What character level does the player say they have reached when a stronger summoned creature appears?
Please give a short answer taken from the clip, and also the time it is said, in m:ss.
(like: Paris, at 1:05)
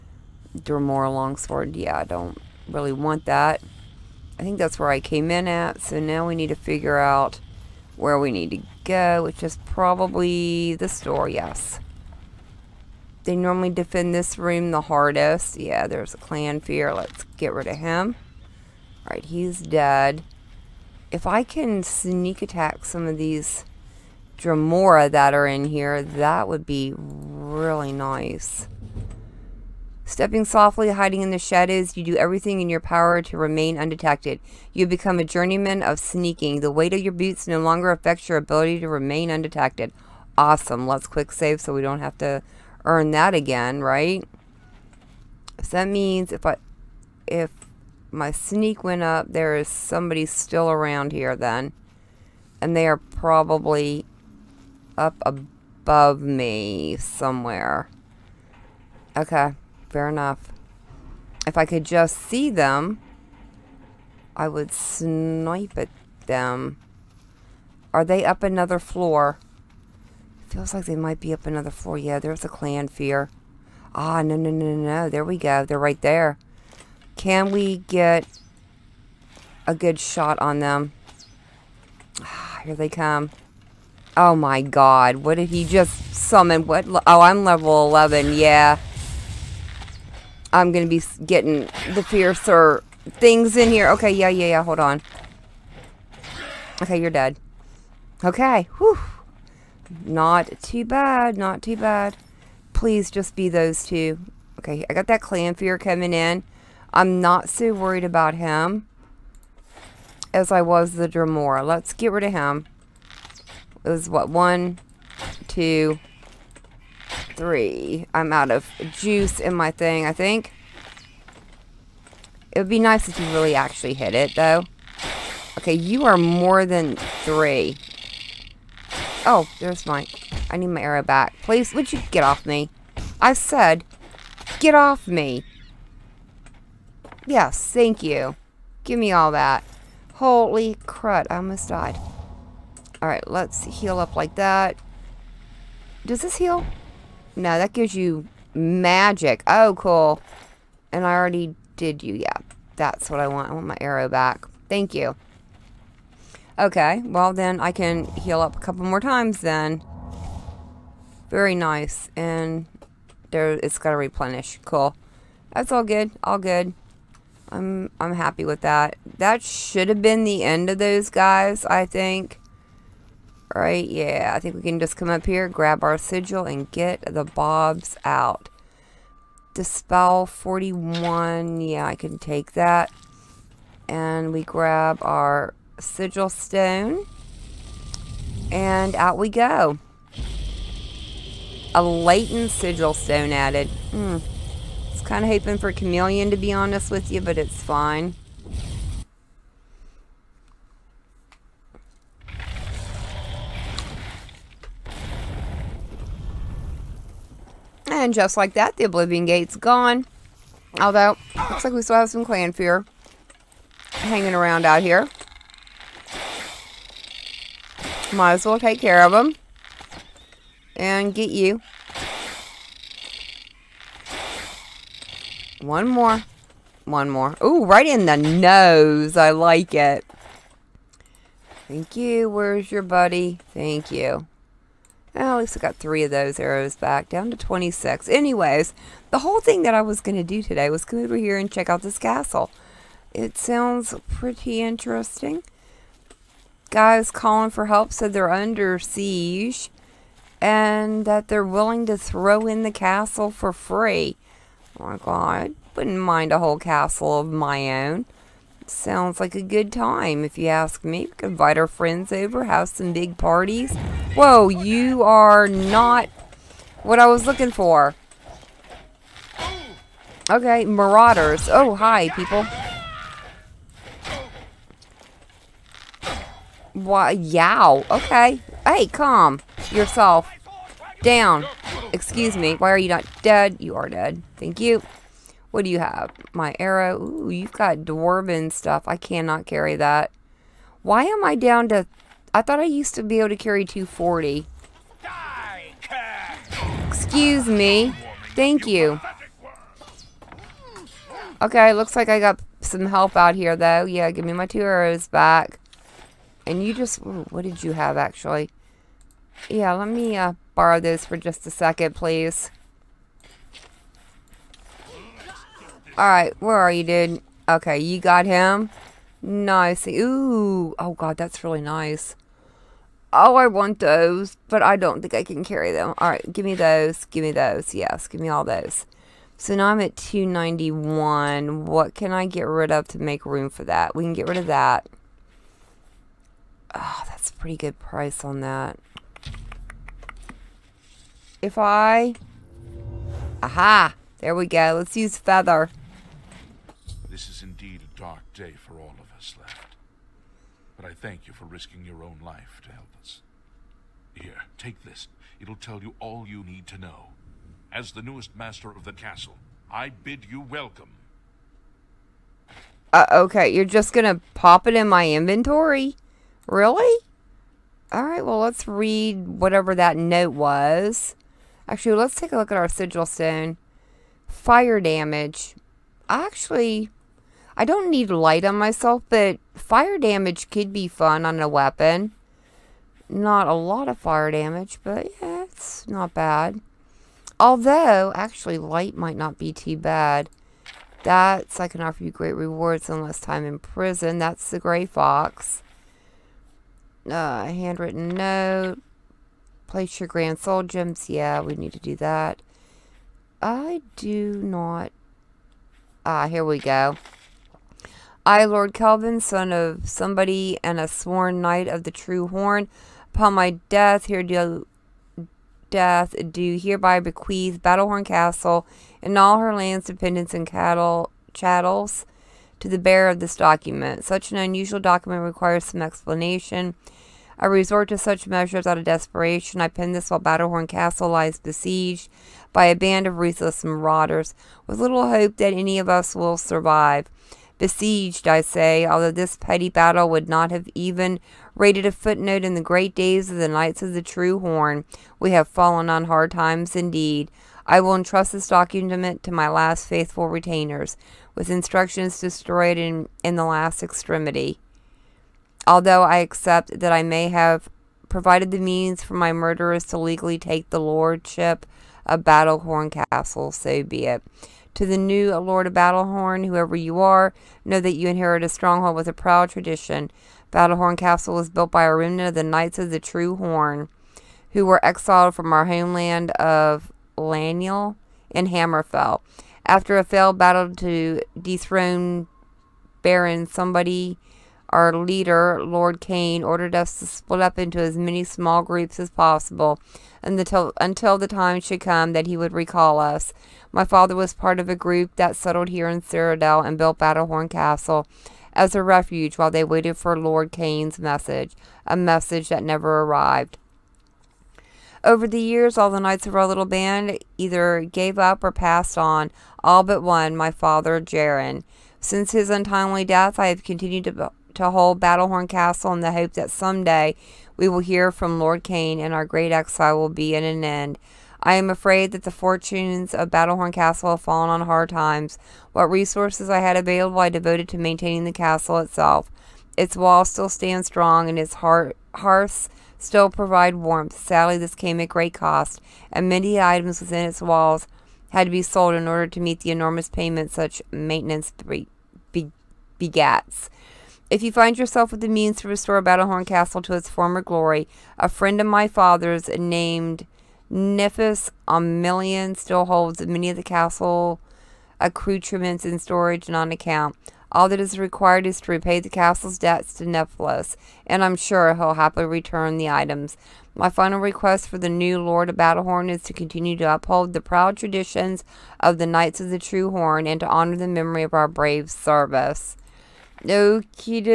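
11, at 1:27.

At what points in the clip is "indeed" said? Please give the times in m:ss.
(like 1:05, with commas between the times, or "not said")
5:47, 7:26.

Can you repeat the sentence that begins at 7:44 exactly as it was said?
To the new Lord of Battlehorn, whoever you are, know that you inherit a stronghold with a proud tradition.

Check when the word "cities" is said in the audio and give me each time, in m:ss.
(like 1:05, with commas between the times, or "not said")
not said.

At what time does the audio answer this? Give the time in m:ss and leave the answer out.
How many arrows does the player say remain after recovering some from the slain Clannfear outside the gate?
3:57.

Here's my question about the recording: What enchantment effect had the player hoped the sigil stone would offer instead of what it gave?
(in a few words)
Chameleon.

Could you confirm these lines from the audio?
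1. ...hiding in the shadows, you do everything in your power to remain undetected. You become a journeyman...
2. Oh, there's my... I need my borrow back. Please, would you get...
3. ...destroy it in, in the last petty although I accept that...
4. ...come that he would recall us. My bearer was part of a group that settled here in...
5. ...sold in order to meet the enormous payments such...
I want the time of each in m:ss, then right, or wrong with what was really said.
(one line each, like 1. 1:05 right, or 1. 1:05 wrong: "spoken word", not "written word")
1. 0:30 right
2. 2:09 wrong: "arrow", not "borrow"
3. 7:32 wrong: "extremity", not "petty"
4. 8:11 wrong: "father", not "bearer"
5. 8:58 right.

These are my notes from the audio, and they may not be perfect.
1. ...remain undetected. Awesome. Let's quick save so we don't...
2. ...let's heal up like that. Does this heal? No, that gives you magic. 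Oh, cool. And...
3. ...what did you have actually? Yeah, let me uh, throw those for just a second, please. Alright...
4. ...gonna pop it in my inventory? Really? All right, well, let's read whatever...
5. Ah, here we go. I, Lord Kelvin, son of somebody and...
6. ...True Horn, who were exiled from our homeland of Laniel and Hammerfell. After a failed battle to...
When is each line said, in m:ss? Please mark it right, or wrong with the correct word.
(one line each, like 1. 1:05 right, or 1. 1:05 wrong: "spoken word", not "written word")
1. 0:38 right
2. 2:23 right
3. 5:06 wrong: "borrow", not "throw"
4. 6:03 right
5. 6:46 right
6. 7:52 right.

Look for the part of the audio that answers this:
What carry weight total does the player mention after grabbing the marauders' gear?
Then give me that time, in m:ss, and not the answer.
5:29.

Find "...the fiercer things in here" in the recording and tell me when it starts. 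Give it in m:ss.
1:31.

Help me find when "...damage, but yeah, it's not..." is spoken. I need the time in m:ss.
6:24.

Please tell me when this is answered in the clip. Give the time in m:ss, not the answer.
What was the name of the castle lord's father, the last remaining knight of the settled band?
8:30.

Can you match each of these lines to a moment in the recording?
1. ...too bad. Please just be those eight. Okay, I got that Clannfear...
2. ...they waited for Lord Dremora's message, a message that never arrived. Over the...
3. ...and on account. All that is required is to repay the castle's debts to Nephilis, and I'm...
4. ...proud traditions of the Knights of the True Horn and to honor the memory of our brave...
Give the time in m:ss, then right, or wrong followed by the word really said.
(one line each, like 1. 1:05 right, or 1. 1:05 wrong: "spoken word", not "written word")
1. 1:41 wrong: "two", not "eight"
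2. 8:19 wrong: "Kane", not "Dremora"
3. 9:16 right
4. 9:27 right.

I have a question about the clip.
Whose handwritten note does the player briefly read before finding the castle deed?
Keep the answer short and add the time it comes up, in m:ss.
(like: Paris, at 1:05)
The Gray Fox, at 6:34.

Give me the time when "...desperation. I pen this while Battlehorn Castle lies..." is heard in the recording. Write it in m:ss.
7:08.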